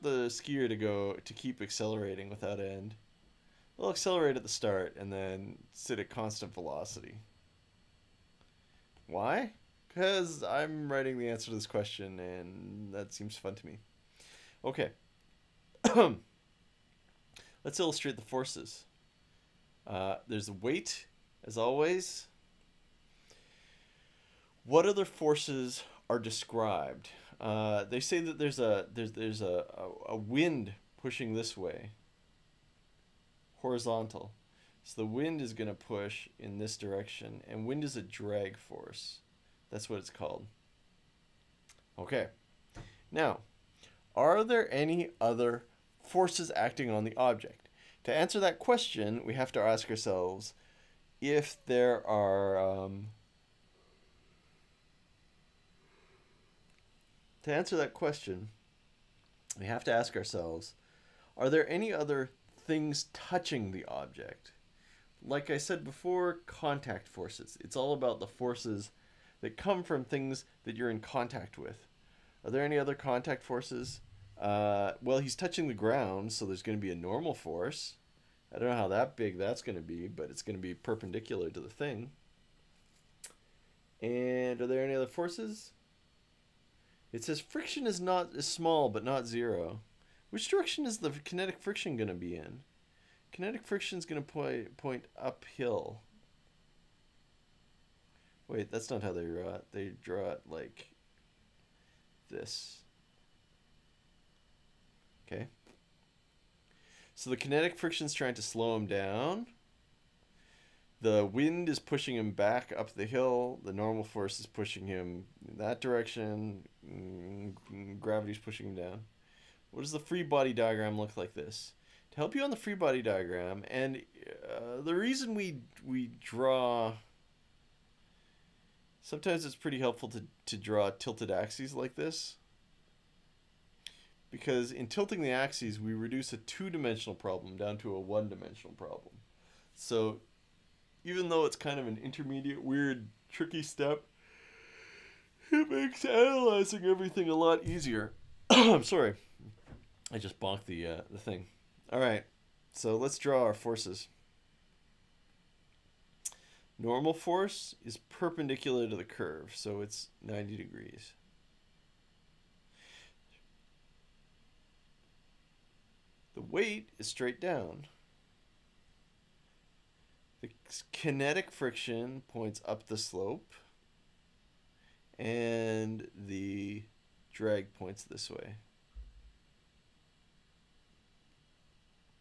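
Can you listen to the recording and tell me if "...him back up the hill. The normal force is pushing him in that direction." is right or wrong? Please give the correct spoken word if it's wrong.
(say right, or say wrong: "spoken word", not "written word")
right.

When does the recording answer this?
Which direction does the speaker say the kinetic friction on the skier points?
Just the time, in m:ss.
1:34.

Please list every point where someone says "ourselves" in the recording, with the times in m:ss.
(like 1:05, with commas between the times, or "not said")
0:49, 1:00.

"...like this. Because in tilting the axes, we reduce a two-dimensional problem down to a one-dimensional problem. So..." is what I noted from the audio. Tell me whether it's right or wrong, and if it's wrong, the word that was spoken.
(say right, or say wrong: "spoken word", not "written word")
right.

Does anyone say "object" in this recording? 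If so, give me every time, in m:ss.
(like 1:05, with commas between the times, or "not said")
0:47, 1:03.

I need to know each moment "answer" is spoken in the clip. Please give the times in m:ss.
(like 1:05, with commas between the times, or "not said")
0:11, 0:48, 0:57.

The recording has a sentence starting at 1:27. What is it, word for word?
It says friction is not is small but not zero.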